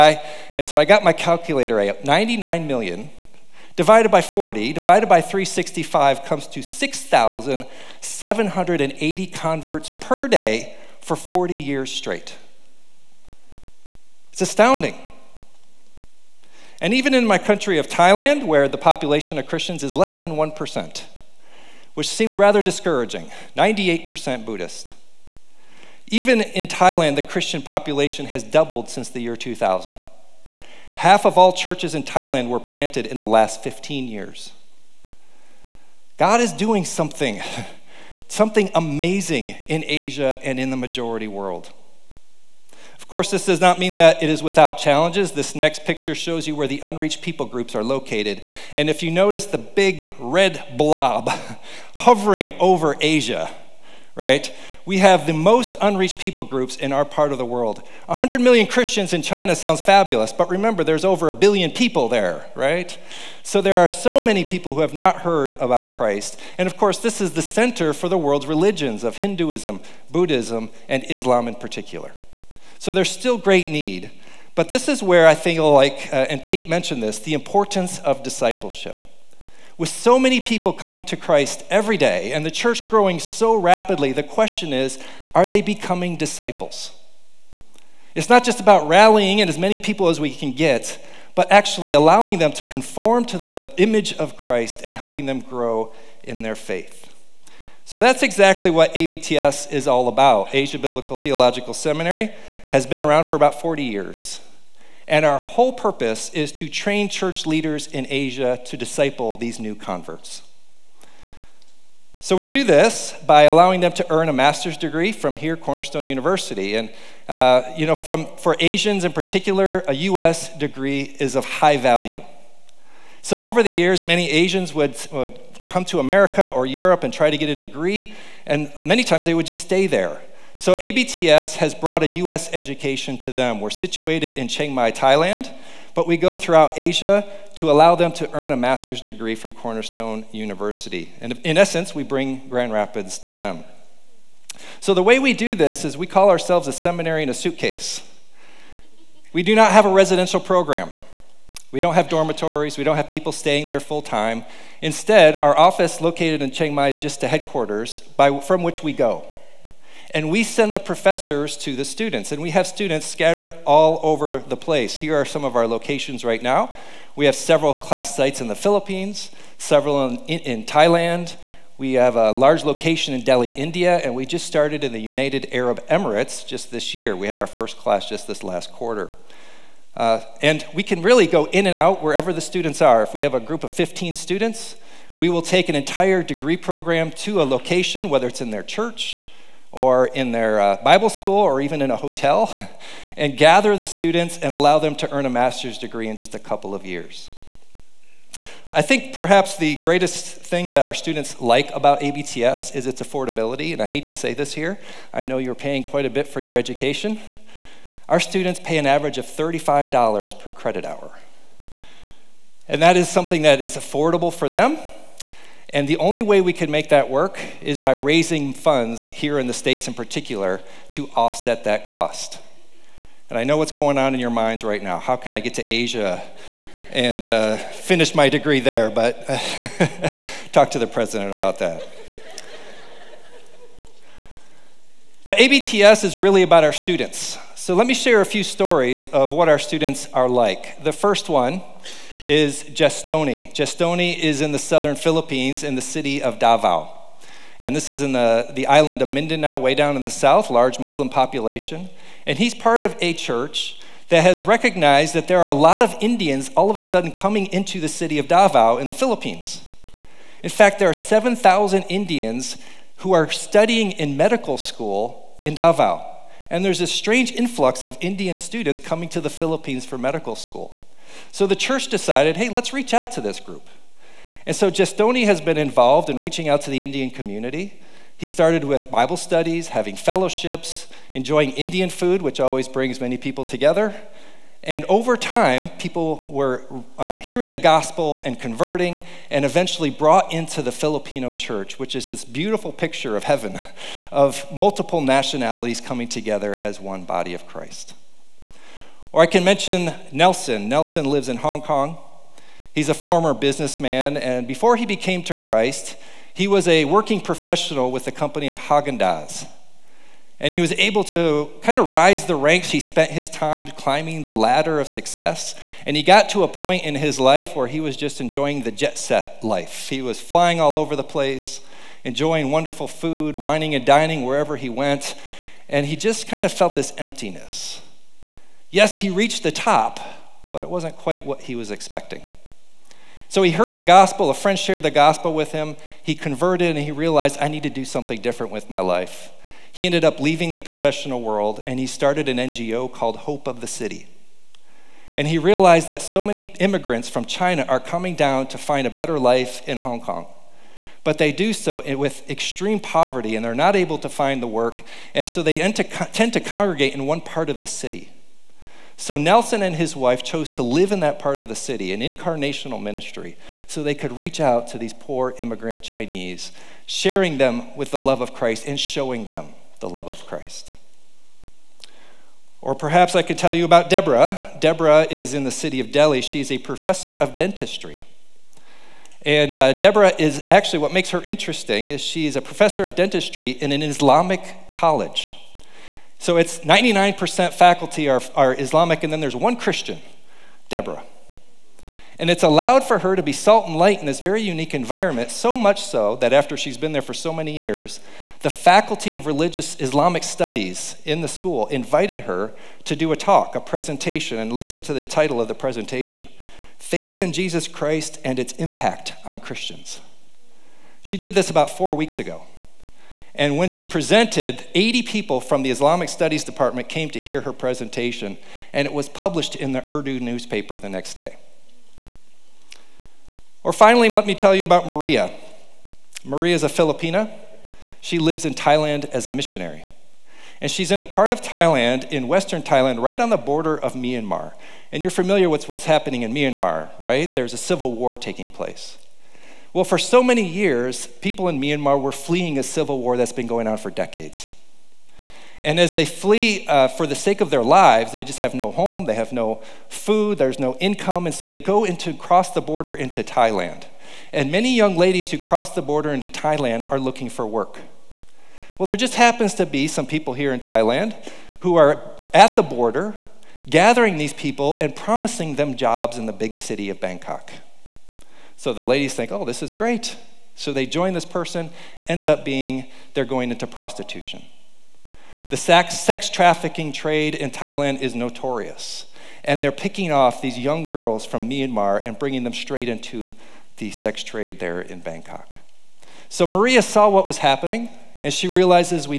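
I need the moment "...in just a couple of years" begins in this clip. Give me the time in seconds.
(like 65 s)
196 s.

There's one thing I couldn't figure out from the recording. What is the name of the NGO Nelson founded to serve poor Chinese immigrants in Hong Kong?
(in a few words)
Hope of the City.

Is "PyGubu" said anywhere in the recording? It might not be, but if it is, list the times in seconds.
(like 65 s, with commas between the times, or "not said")
not said.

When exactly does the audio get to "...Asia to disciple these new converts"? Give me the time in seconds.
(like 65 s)
108 s.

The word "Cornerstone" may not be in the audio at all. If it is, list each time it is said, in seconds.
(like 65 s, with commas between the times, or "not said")
115 s, 139 s.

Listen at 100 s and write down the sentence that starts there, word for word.
Asia Biblical Theological Seminary has been around for about 40 years.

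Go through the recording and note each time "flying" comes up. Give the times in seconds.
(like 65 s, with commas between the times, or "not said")
320 s.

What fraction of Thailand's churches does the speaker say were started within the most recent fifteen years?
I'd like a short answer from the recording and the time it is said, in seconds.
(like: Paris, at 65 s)
Half, at 30 s.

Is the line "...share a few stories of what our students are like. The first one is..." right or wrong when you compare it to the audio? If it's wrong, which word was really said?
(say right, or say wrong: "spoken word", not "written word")
right.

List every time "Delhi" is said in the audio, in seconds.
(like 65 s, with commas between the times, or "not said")
173 s, 375 s.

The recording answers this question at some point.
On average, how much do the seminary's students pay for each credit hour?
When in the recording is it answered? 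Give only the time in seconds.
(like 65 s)
209 s.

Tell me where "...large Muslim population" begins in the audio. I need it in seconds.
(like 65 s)
250 s.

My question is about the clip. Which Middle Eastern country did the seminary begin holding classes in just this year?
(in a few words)
United Arab Emirates.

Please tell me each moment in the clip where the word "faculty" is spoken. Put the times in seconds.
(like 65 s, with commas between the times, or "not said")
387 s, 398 s.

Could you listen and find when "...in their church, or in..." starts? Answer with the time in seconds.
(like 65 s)
188 s.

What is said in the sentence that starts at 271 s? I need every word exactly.
So the church decided hey, let's reach out to this group.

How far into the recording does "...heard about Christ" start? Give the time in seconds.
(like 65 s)
65 s.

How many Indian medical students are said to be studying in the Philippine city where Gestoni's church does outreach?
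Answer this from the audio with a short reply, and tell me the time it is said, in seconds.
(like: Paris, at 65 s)
7,000, at 260 s.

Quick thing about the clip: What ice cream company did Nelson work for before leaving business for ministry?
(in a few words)
Haagen-Dazs.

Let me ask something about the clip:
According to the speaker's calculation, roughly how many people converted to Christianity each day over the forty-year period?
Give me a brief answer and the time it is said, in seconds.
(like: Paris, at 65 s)
6,780, at 6 s.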